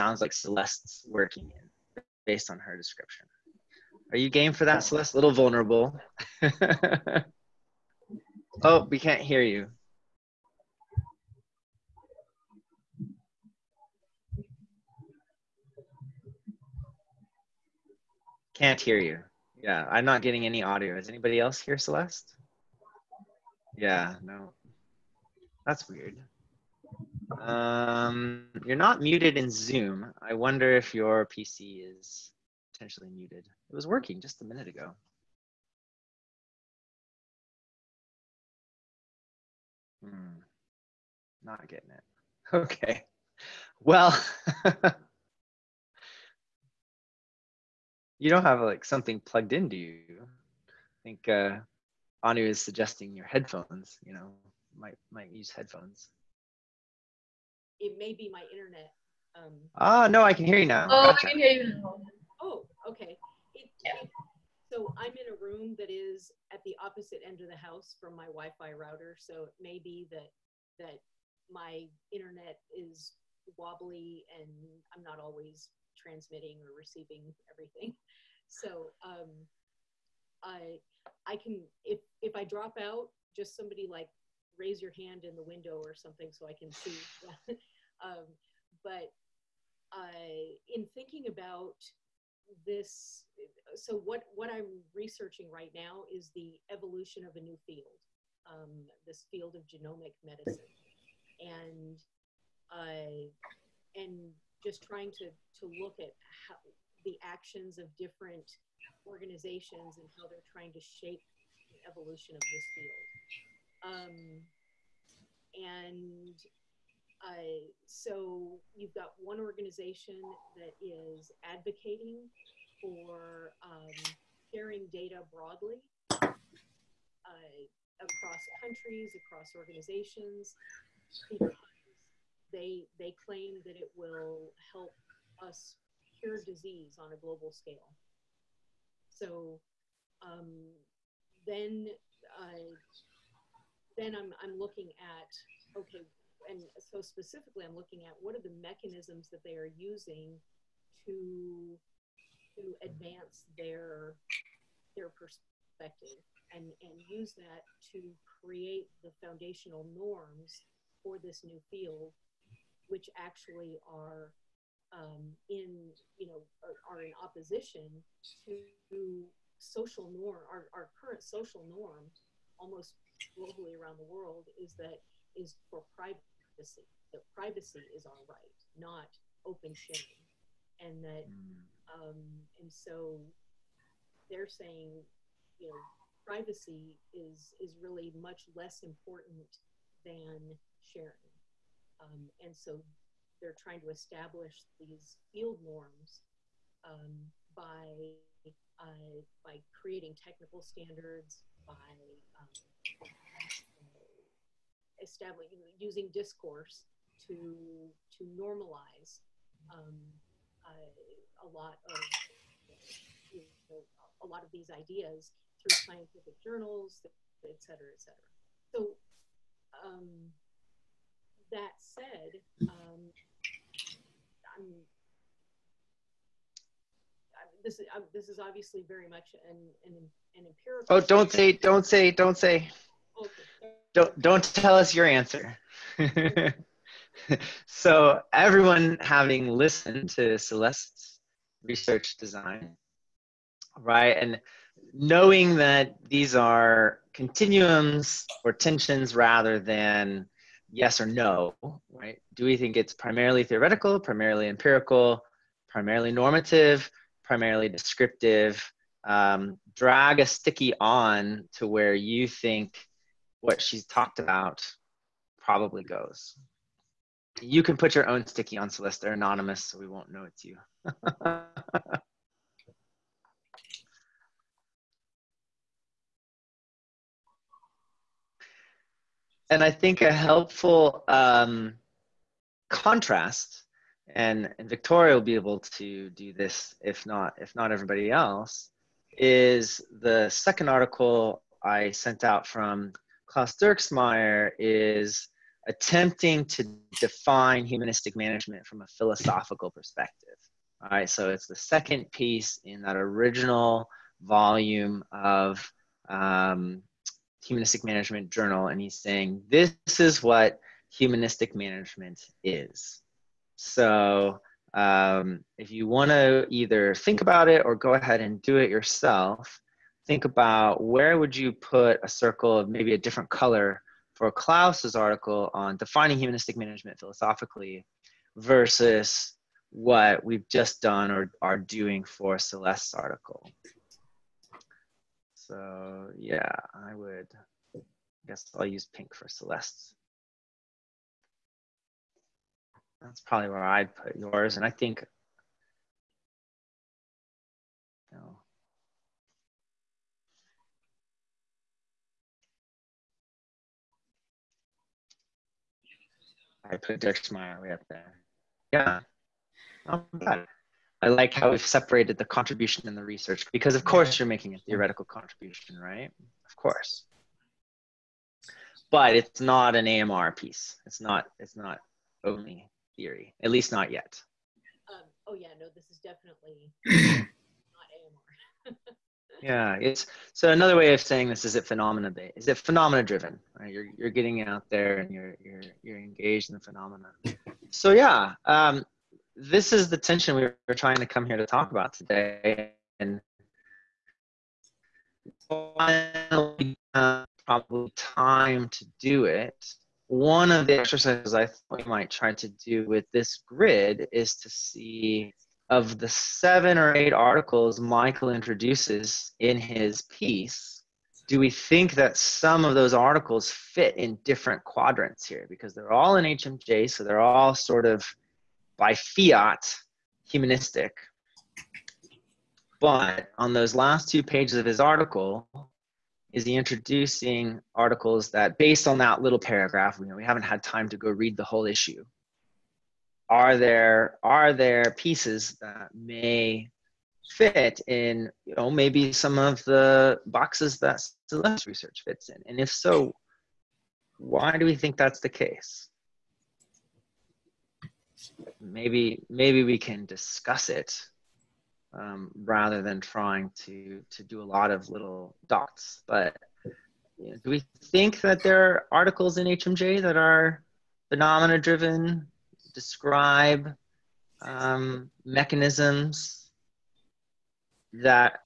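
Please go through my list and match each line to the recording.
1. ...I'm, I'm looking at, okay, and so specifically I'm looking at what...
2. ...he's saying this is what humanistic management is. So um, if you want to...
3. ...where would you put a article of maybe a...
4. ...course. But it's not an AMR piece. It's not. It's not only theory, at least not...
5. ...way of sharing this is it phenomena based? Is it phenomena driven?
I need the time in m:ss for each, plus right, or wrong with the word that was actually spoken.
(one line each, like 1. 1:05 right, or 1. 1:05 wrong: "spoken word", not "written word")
1. 2:24 right
2. 5:08 right
3. 5:20 wrong: "circle", not "article"
4. 6:06 right
5. 6:20 wrong: "saying", not "sharing".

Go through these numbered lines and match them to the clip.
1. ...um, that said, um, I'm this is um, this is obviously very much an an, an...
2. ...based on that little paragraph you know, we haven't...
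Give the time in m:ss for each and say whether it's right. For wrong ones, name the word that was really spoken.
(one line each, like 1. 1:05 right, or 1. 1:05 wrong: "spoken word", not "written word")
1. 3:39 right
2. 7:08 right.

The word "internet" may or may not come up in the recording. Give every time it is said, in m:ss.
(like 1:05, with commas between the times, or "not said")
0:58, 1:12.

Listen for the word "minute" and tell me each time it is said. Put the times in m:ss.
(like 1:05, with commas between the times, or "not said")
0:34.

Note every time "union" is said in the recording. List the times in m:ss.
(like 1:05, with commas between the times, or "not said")
not said.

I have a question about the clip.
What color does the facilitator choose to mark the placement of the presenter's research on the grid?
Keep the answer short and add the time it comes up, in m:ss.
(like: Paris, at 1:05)
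Pink, at 5:38.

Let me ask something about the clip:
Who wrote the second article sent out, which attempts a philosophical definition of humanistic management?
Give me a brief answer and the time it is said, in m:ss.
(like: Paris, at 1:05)
Klaus Dierksmeier, at 4:53.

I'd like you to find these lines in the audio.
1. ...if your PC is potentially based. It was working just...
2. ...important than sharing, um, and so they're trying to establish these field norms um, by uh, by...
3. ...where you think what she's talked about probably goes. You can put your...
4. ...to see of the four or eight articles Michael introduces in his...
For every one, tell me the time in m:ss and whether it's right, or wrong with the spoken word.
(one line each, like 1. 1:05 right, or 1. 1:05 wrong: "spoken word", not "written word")
1. 0:30 wrong: "muted", not "based"
2. 3:08 right
3. 4:21 right
4. 6:44 wrong: "seven", not "four".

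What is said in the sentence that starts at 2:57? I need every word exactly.
That privacy is our right, not open sharing, and that mm.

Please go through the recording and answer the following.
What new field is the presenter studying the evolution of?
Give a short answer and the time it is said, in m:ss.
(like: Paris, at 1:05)
Genomic medicine, at 1:39.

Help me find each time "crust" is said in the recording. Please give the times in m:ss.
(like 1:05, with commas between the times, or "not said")
not said.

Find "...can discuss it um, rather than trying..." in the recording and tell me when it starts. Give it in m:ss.
7:29.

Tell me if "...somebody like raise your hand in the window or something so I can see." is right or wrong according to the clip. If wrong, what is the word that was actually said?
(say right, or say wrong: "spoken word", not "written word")
right.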